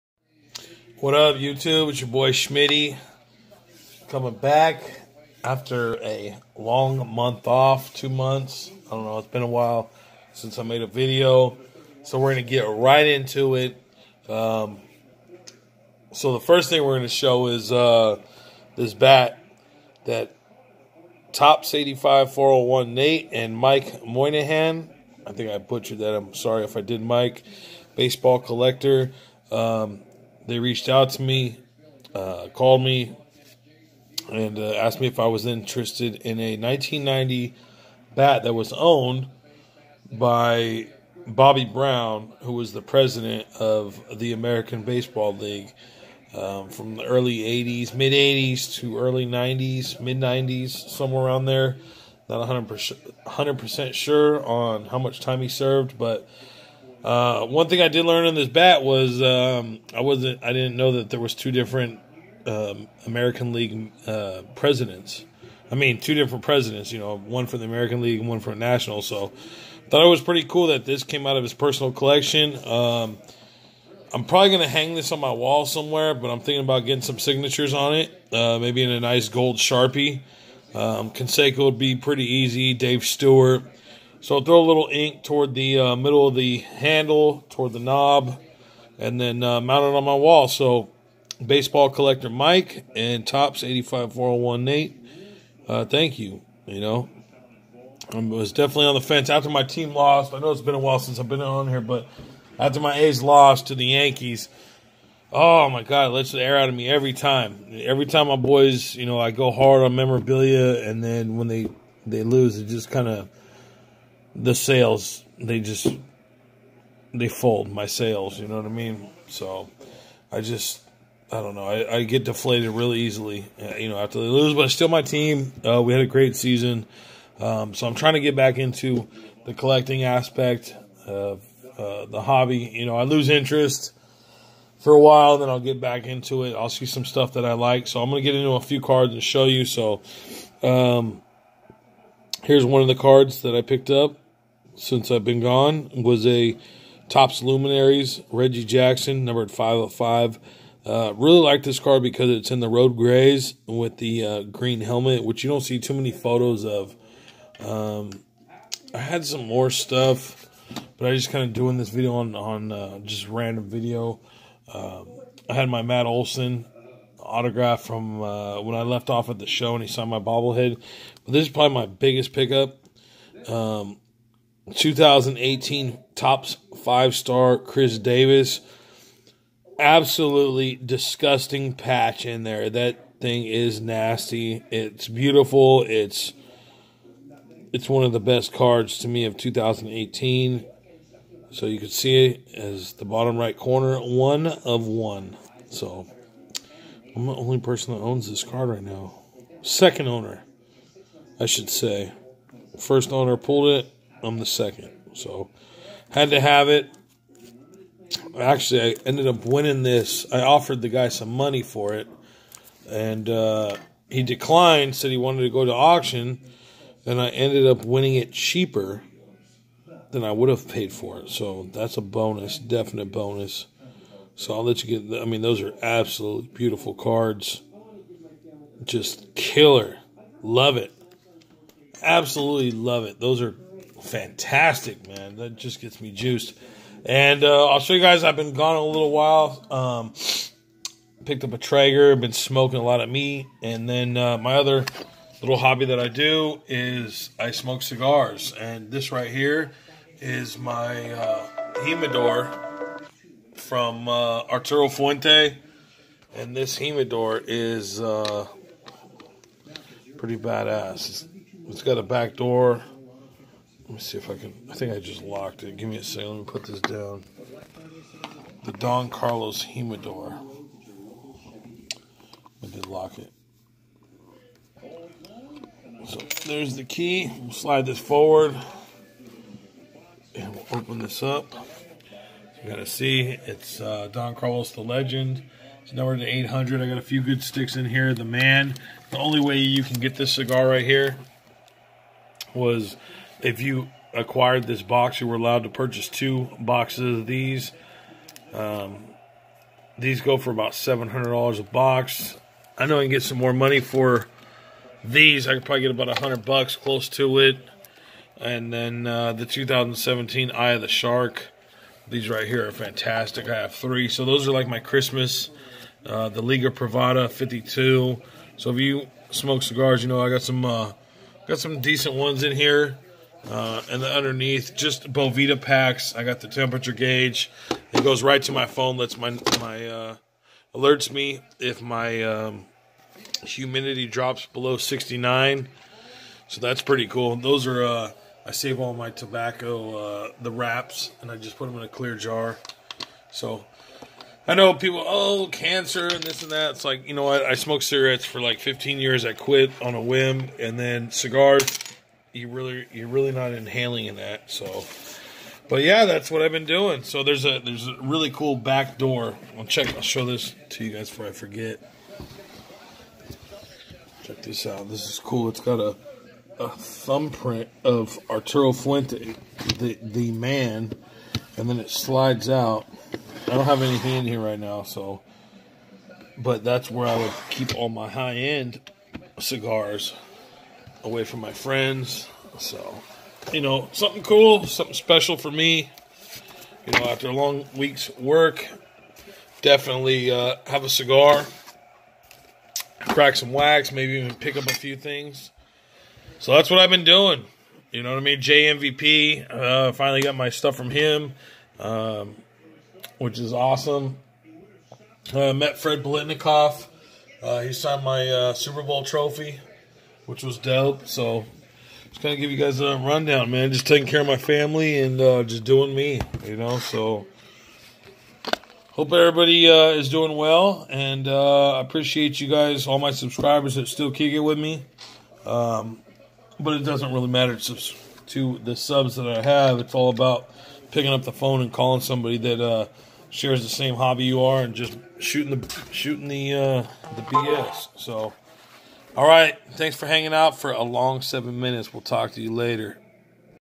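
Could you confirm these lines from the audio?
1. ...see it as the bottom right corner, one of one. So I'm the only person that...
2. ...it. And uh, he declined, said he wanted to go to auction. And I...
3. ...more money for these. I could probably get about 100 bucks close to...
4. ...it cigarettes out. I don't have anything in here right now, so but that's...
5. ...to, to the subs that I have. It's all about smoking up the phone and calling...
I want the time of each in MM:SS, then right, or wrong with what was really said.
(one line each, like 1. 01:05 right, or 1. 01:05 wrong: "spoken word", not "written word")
1. 03:11 right
2. 03:31 right
3. 05:03 right
4. 06:11 wrong: "slides", not "cigarettes"
5. 07:07 wrong: "picking", not "smoking".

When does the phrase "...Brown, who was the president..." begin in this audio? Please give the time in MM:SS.
00:41.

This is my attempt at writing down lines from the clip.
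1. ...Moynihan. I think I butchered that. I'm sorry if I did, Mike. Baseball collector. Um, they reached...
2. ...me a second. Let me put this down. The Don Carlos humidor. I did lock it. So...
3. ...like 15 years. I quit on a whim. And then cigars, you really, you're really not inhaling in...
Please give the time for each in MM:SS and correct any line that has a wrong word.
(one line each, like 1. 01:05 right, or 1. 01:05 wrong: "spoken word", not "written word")
1. 00:24 right
2. 04:25 right
3. 05:48 right.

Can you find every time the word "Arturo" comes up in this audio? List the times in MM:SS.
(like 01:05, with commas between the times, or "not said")
04:14, 06:08.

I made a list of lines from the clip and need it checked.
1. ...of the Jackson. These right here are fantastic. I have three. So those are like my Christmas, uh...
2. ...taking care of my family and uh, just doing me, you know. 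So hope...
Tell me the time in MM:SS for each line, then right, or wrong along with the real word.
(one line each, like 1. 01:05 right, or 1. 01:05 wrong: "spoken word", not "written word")
1. 05:10 wrong: "Shark", not "Jackson"
2. 06:53 right.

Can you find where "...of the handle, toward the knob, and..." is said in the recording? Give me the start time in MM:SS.
01:26.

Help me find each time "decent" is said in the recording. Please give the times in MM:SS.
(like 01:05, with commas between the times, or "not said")
05:21.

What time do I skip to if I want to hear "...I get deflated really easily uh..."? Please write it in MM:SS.
02:01.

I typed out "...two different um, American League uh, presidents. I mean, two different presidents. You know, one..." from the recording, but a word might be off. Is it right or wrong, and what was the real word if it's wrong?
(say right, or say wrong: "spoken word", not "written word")
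right.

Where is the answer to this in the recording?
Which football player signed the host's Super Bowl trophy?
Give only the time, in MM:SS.
06:45.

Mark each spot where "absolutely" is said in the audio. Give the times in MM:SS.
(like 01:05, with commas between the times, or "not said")
02:59, 03:45, 03:52.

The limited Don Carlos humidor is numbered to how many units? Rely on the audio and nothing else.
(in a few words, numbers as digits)
800.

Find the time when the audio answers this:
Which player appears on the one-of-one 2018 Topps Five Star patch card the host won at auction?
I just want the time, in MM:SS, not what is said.
02:57.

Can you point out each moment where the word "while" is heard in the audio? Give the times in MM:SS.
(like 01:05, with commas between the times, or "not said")
00:09, 01:40, 02:14, 03:59.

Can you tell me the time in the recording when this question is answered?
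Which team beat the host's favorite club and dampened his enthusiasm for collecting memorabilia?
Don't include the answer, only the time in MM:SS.
01:43.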